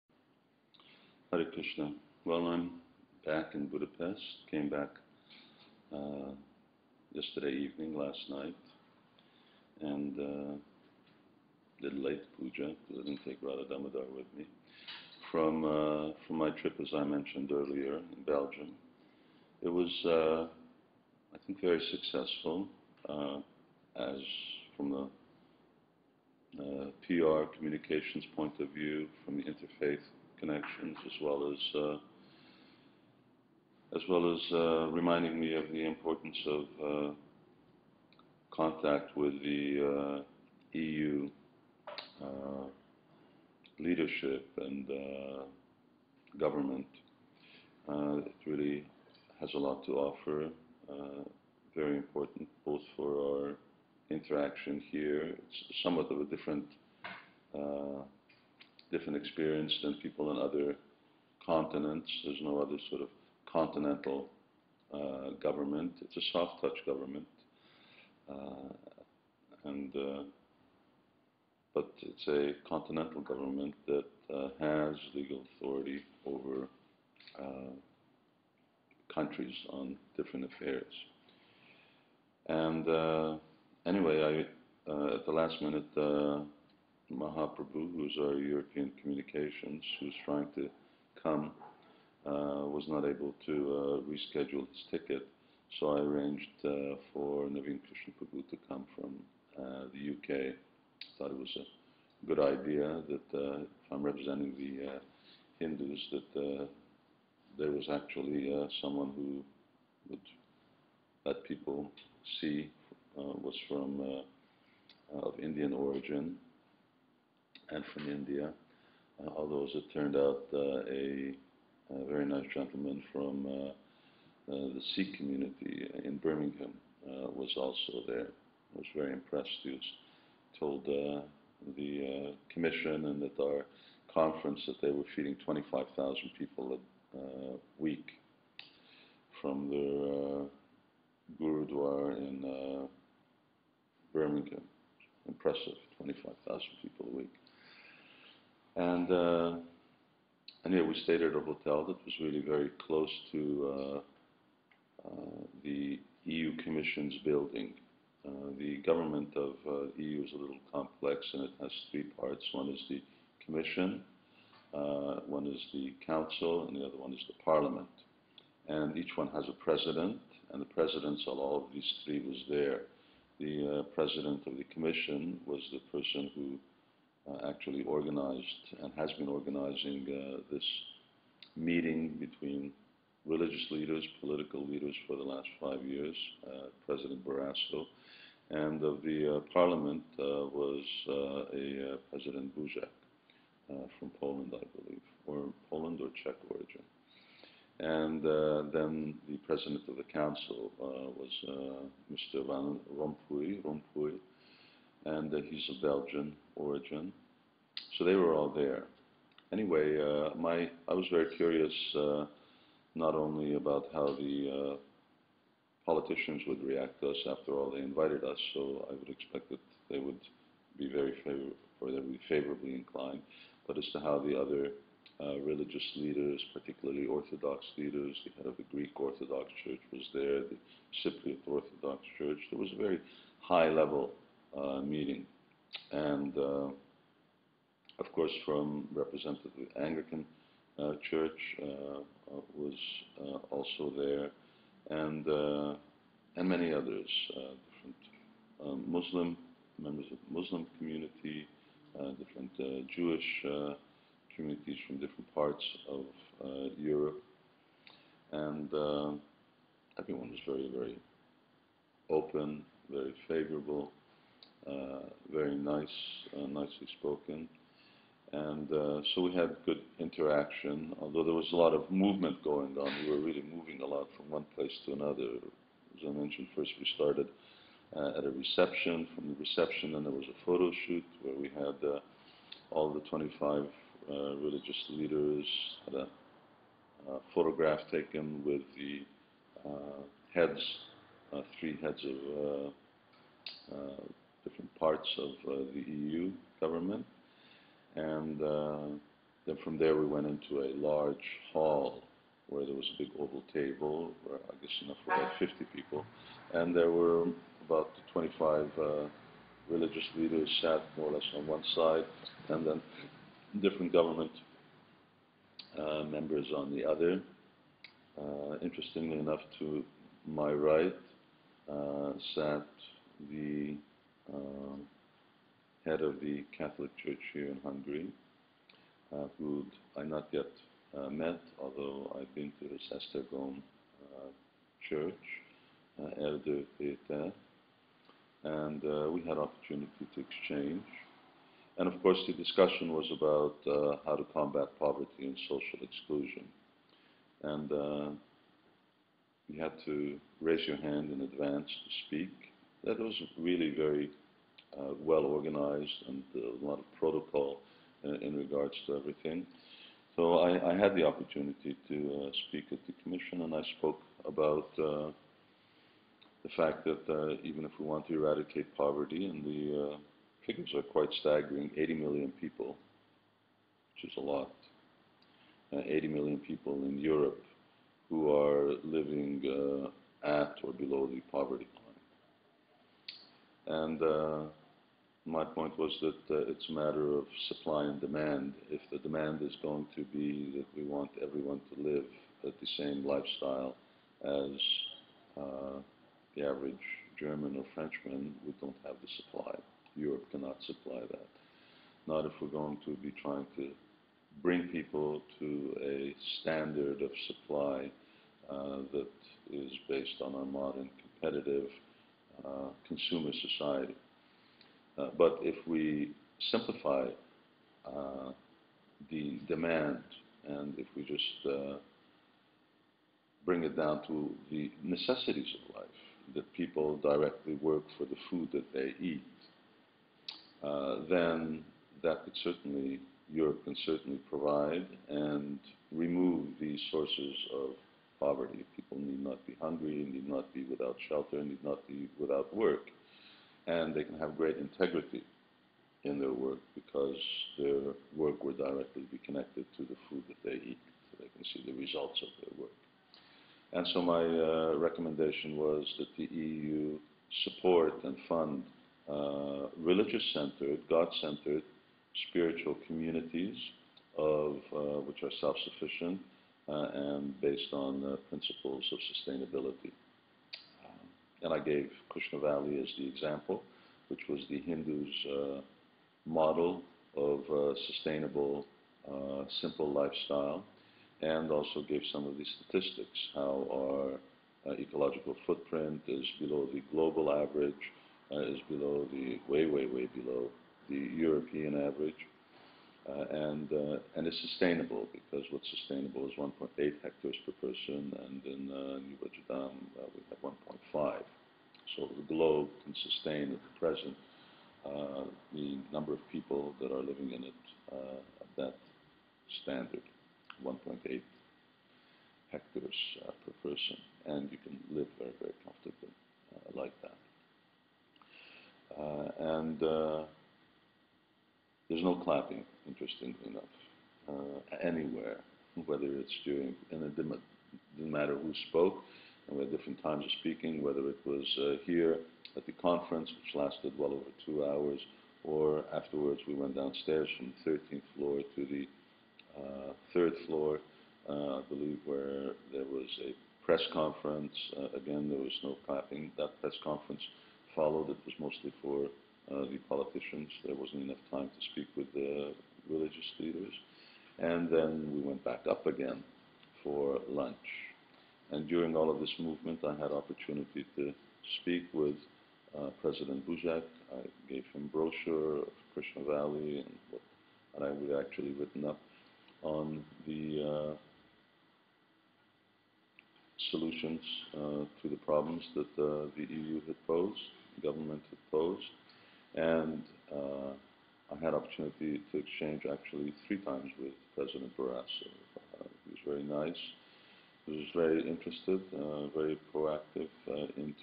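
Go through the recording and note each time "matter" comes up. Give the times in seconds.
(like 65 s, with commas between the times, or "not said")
386 s, 527 s.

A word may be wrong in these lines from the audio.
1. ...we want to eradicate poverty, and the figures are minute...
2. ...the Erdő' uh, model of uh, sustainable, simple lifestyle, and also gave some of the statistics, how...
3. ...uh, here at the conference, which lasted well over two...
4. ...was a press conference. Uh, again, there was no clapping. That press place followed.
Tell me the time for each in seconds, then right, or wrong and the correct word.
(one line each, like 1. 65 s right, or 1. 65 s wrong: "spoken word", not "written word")
1. 367 s wrong: "quite", not "minute"
2. 474 s wrong: "Hindus", not "Erdő"
3. 531 s right
4. 542 s wrong: "conference", not "place".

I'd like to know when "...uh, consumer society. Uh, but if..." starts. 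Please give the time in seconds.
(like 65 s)
412 s.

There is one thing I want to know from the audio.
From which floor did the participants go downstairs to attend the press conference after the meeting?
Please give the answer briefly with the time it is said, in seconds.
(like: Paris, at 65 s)
13th floor, at 537 s.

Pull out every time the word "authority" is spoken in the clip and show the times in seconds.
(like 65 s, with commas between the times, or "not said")
75 s.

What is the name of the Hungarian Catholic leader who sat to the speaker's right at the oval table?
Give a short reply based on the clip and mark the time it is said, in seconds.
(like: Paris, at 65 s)
Erdő Péter, at 336 s.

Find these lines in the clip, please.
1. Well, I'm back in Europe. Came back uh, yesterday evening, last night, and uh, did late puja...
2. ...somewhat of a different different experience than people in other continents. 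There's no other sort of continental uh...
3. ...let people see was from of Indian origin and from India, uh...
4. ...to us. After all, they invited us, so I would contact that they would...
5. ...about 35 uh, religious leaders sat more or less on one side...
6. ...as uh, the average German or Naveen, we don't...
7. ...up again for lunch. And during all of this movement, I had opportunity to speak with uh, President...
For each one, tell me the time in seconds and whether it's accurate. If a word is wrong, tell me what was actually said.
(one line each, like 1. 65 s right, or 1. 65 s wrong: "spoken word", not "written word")
1. 2 s wrong: "Budapest", not "Europe"
2. 55 s right
3. 111 s right
4. 217 s wrong: "expect", not "contact"
5. 307 s wrong: "25", not "35"
6. 394 s wrong: "Frenchman", not "Naveen"
7. 555 s right.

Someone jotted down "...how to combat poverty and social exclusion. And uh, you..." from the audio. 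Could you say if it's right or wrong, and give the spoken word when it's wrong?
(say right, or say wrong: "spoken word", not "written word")
right.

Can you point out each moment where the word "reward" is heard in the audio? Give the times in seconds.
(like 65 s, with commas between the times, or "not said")
not said.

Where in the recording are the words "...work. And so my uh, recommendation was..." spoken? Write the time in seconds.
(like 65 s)
452 s.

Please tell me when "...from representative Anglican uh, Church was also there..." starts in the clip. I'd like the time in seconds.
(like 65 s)
238 s.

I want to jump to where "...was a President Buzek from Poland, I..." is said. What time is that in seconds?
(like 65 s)
190 s.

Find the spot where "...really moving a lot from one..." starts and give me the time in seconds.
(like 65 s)
273 s.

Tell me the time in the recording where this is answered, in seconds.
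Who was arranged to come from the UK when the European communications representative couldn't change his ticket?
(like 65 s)
97 s.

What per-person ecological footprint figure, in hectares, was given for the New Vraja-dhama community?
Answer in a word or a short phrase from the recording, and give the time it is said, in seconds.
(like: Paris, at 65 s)
1.5, at 500 s.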